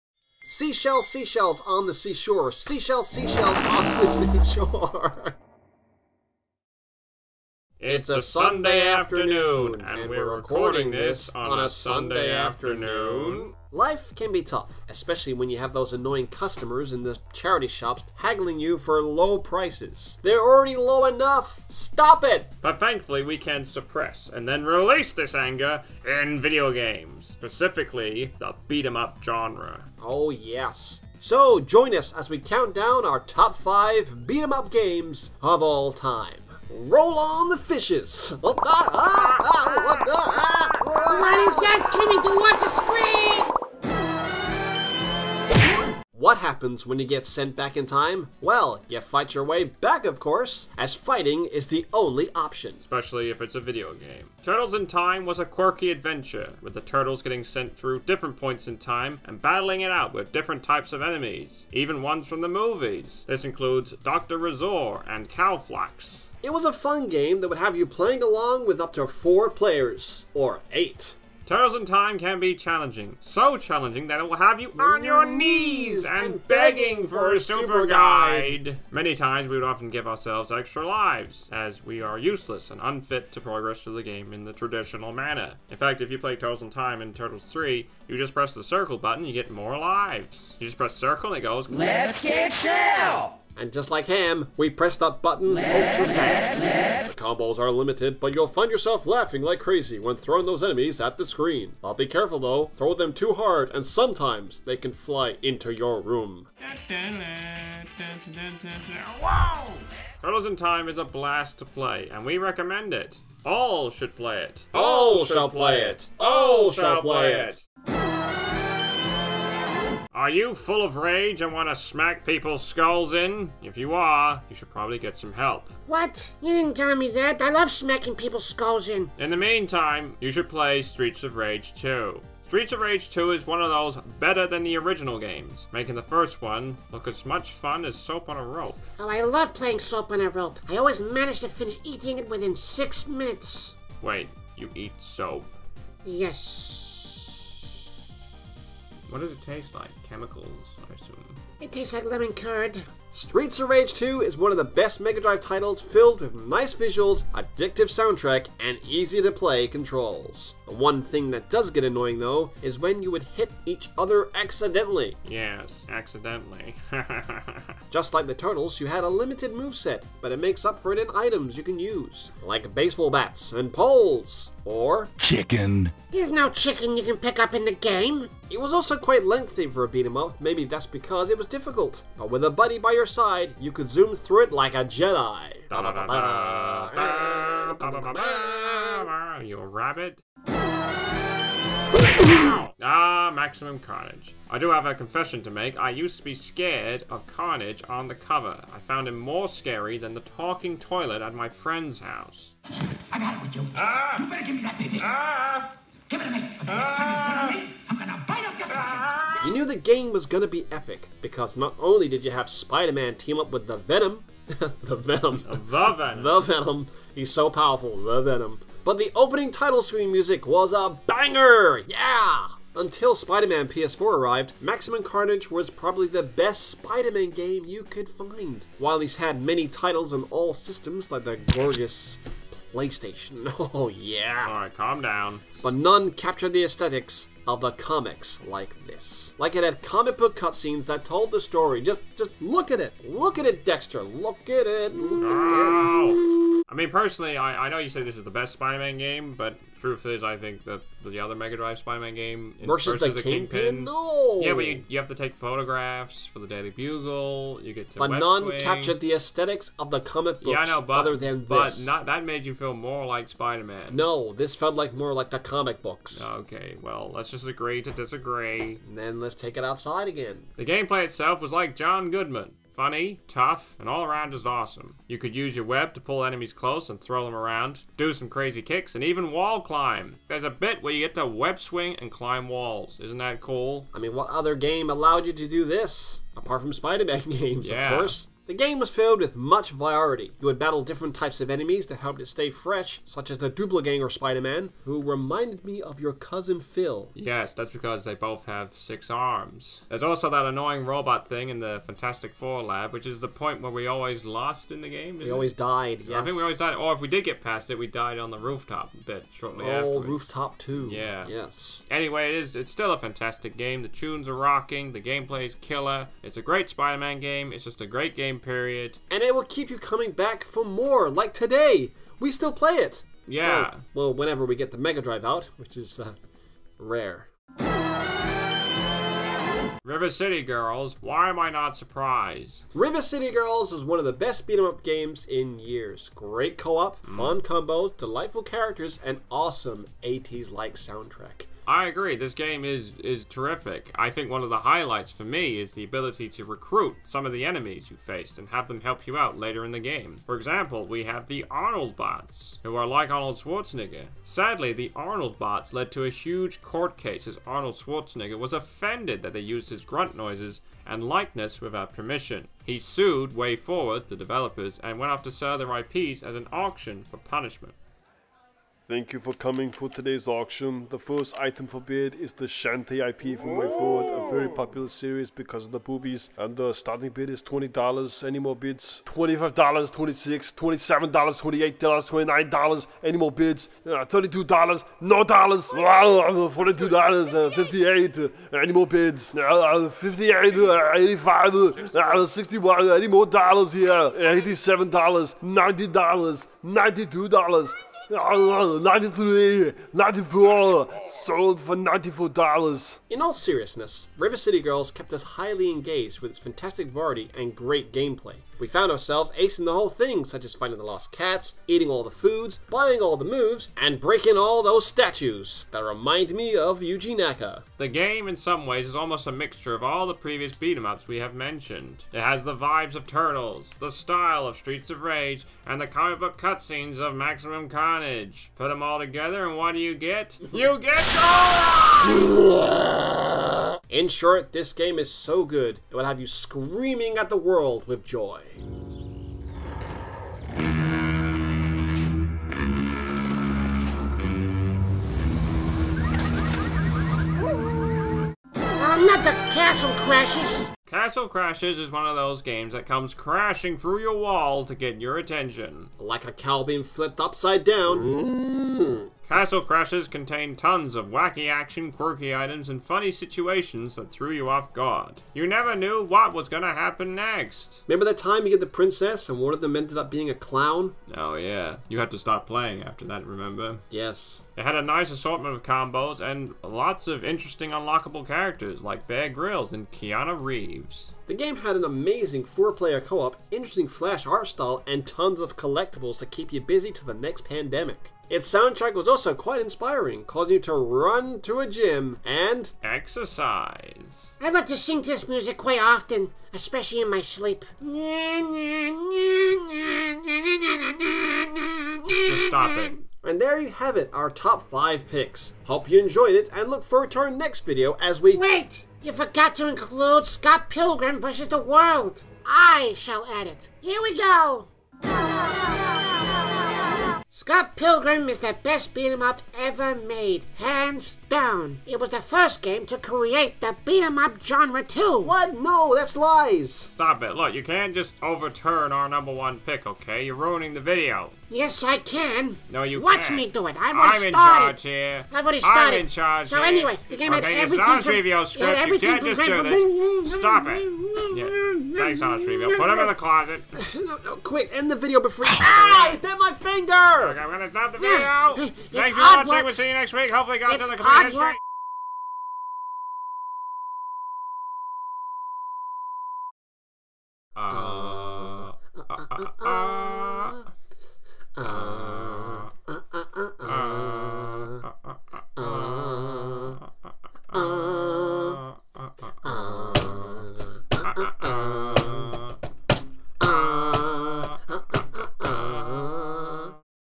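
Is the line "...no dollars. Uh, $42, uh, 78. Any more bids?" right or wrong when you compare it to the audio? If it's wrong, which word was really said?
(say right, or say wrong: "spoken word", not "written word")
wrong: "58", not "78".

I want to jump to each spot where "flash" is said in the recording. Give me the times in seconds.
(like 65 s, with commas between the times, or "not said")
483 s.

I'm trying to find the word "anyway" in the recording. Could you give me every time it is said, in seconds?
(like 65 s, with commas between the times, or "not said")
311 s, 536 s.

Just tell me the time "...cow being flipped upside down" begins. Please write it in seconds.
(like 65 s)
456 s.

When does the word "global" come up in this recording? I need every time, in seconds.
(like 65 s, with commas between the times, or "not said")
not said.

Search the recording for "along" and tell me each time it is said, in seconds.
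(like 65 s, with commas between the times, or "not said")
68 s.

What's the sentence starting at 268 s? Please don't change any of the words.
And then let's take it outside again.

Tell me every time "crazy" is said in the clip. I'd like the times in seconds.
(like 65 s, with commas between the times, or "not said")
99 s, 278 s.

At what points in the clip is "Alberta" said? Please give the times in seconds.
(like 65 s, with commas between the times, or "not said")
not said.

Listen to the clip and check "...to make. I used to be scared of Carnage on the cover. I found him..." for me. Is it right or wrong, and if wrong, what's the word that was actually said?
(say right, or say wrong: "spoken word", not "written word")
right.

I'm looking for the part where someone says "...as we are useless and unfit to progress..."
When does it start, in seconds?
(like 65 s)
81 s.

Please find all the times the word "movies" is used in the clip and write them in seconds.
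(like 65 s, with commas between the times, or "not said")
62 s.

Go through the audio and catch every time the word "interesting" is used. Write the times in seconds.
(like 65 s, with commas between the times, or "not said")
477 s, 483 s.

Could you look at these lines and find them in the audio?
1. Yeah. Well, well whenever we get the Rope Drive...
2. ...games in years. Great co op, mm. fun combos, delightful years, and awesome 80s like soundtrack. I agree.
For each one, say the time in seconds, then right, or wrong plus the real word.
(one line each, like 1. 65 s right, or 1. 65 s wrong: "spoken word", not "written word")
1. 323 s wrong: "Mega", not "Rope"
2. 334 s wrong: "characters", not "years".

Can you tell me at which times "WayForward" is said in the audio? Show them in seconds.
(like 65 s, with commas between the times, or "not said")
363 s, 373 s.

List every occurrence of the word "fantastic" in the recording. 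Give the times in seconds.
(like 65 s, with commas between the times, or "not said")
301 s, 312 s, 406 s.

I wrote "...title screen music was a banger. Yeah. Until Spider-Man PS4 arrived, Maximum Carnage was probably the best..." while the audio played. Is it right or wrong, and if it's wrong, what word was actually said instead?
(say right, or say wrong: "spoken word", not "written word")
right.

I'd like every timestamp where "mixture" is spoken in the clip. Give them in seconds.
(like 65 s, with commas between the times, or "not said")
419 s.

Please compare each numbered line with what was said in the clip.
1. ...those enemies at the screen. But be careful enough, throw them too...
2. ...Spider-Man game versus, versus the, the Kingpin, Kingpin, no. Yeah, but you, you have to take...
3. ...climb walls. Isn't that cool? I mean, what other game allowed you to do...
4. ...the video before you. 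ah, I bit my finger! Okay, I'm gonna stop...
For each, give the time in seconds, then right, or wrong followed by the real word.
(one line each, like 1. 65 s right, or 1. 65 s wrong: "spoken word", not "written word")
1. 100 s wrong: "though", not "enough"
2. 251 s right
3. 282 s right
4. 544 s right.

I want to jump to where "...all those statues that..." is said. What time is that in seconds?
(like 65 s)
414 s.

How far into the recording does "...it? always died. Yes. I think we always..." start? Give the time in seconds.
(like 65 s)
305 s.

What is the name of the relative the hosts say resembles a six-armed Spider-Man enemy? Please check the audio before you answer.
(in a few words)
Phil.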